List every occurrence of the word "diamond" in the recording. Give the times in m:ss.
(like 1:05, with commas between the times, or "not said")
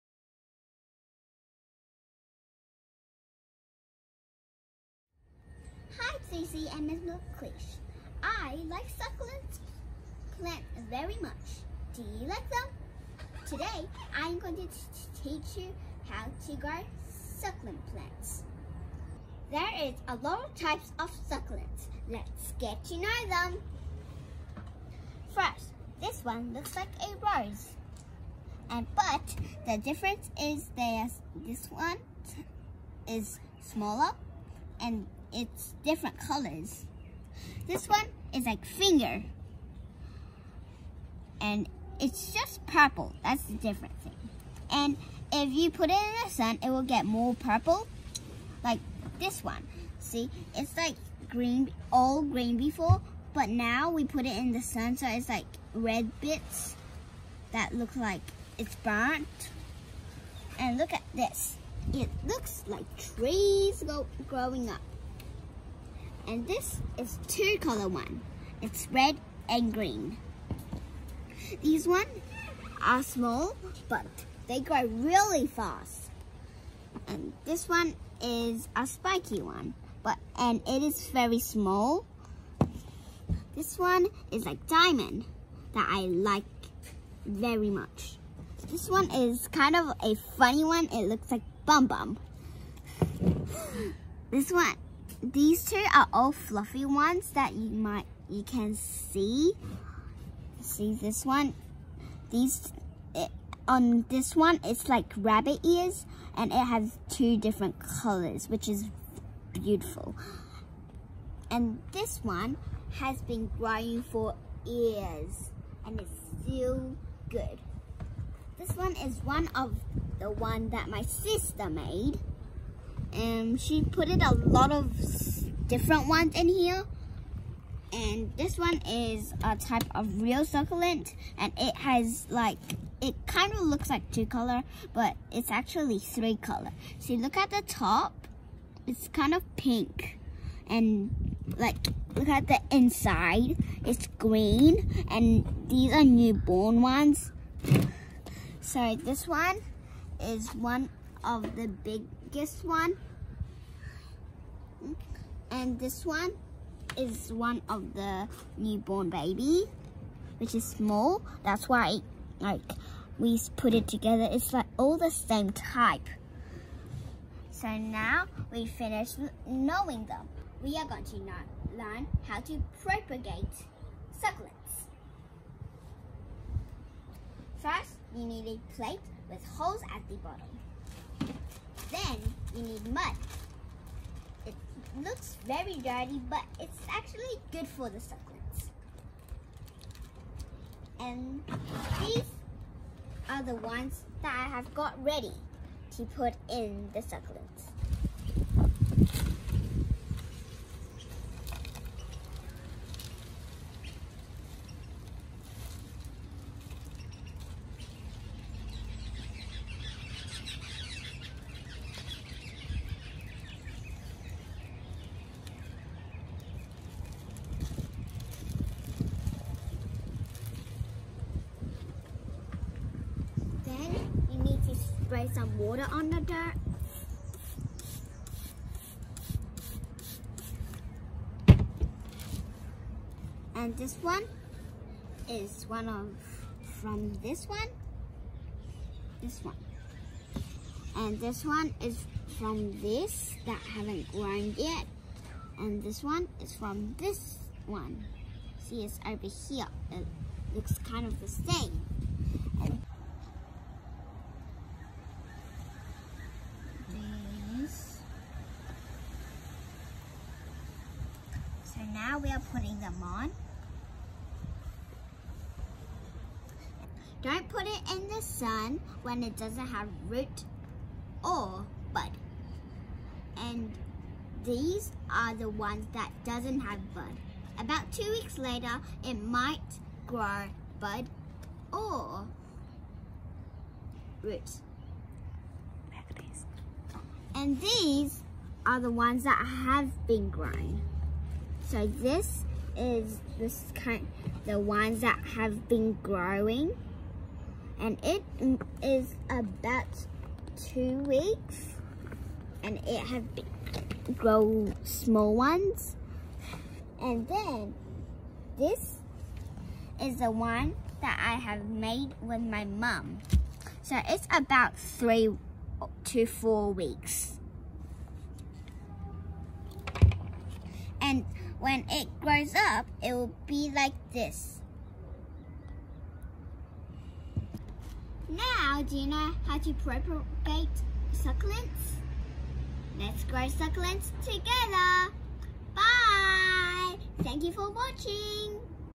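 1:24.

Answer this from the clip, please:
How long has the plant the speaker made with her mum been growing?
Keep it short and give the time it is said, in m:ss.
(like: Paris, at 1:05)
3 to 4 weeks, at 5:14.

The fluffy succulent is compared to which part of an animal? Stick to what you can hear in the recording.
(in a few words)
Rabbit ears.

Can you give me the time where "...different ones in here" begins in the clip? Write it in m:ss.
2:05.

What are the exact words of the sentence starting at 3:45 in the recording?
spray some water on the dirt.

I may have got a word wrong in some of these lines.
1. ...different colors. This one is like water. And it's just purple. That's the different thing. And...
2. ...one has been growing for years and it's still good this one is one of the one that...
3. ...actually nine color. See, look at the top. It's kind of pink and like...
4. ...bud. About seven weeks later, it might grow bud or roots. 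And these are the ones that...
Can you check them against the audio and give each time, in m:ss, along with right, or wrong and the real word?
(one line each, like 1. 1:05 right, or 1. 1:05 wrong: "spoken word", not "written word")
1. 0:35 wrong: "finger", not "water"
2. 1:52 right
3. 2:15 wrong: "three", not "nine"
4. 4:36 wrong: "two", not "seven".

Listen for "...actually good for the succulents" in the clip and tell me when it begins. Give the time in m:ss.
3:06.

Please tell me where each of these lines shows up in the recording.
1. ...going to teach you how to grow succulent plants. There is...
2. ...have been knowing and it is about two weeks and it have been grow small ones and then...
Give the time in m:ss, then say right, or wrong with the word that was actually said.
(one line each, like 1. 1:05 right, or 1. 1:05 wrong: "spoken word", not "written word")
1. 0:14 right
2. 4:55 wrong: "growing", not "knowing".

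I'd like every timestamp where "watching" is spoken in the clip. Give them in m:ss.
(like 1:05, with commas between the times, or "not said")
5:37.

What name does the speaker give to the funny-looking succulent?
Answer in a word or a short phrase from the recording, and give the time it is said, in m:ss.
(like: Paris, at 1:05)
Bum Bum, at 1:31.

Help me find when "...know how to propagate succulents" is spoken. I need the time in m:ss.
5:29.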